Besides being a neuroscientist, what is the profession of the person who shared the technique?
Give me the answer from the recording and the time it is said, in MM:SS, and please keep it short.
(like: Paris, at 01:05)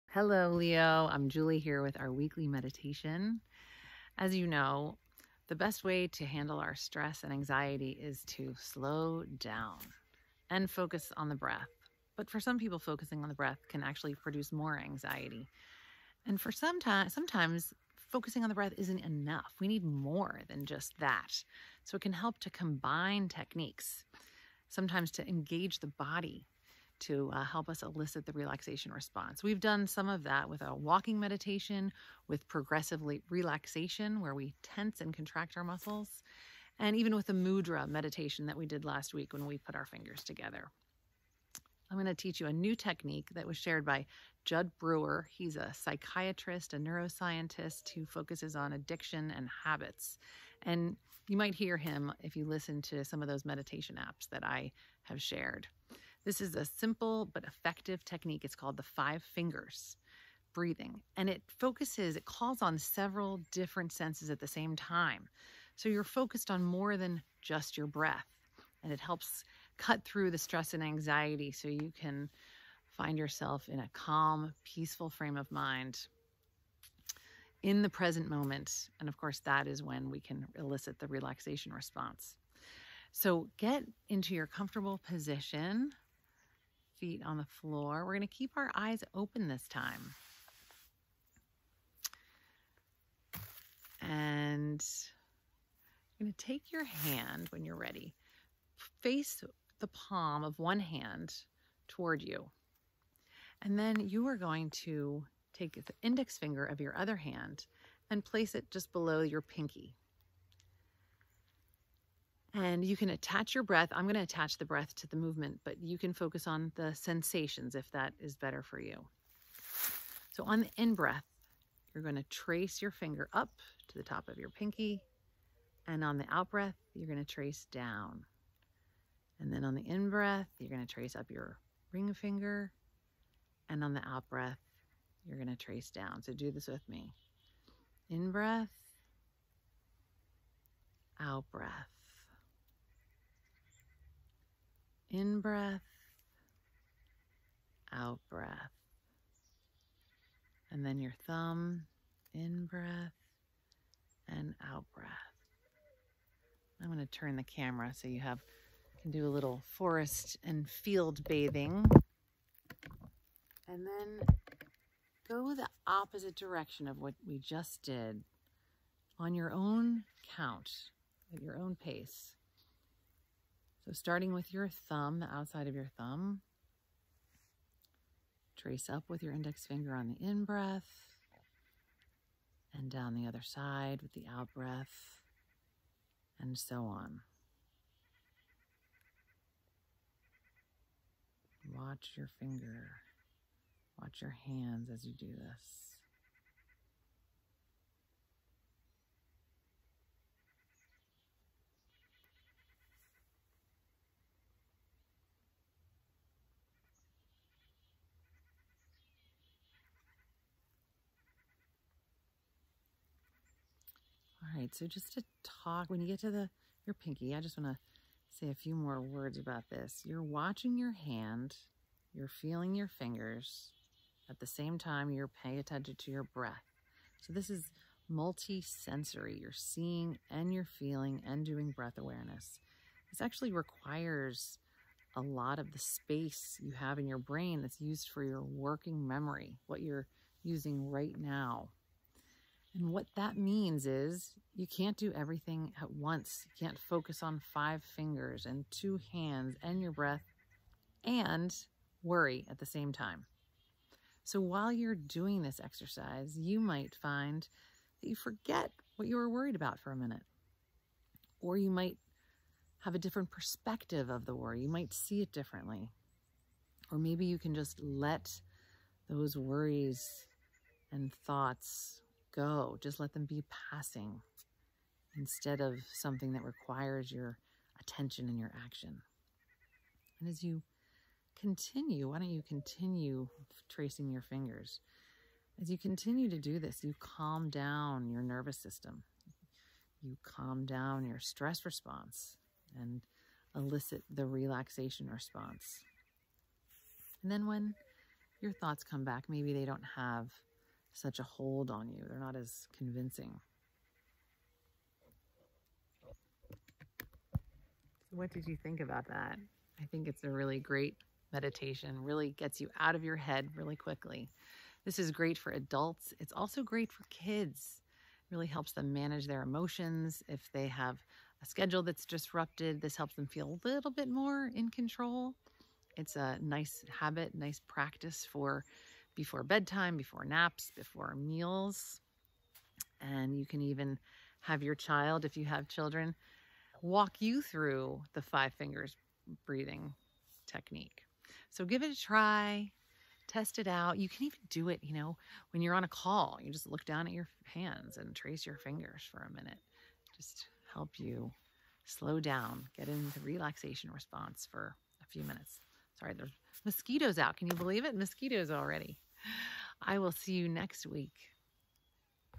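psychiatrist, at 00:45.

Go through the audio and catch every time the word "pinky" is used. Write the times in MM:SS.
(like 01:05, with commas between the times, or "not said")
01:49, 02:04, 03:36.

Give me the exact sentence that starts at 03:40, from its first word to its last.
You're watching your hand, you're feeling your fingers, at the same time you're paying attention to your breath.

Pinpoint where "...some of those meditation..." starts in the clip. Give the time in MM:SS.
00:53.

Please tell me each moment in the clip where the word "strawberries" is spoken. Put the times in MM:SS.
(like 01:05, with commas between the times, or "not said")
not said.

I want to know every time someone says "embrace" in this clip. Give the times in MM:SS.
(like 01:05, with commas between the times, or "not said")
not said.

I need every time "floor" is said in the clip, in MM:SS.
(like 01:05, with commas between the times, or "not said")
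01:27.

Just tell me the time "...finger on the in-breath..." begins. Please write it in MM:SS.
02:59.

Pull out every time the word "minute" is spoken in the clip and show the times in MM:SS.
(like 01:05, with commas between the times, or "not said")
04:19, 05:49, 05:55.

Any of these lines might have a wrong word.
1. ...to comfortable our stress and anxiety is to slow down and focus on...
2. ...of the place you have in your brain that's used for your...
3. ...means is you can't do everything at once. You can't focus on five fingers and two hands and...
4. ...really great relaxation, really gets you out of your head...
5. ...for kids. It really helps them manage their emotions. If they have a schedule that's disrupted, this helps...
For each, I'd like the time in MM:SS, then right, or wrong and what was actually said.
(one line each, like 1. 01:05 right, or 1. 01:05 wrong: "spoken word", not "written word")
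1. 00:06 wrong: "handle", not "comfortable"
2. 03:55 wrong: "space", not "place"
3. 04:03 right
4. 05:10 wrong: "meditation", not "relaxation"
5. 05:16 right.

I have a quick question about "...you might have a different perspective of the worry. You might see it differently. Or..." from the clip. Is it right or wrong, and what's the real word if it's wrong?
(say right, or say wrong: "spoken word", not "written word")
right.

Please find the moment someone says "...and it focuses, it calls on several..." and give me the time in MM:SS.
01:01.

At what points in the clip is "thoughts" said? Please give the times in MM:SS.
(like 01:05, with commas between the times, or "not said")
04:31, 04:58.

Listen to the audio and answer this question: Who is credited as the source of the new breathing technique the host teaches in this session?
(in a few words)
Jud Brewer.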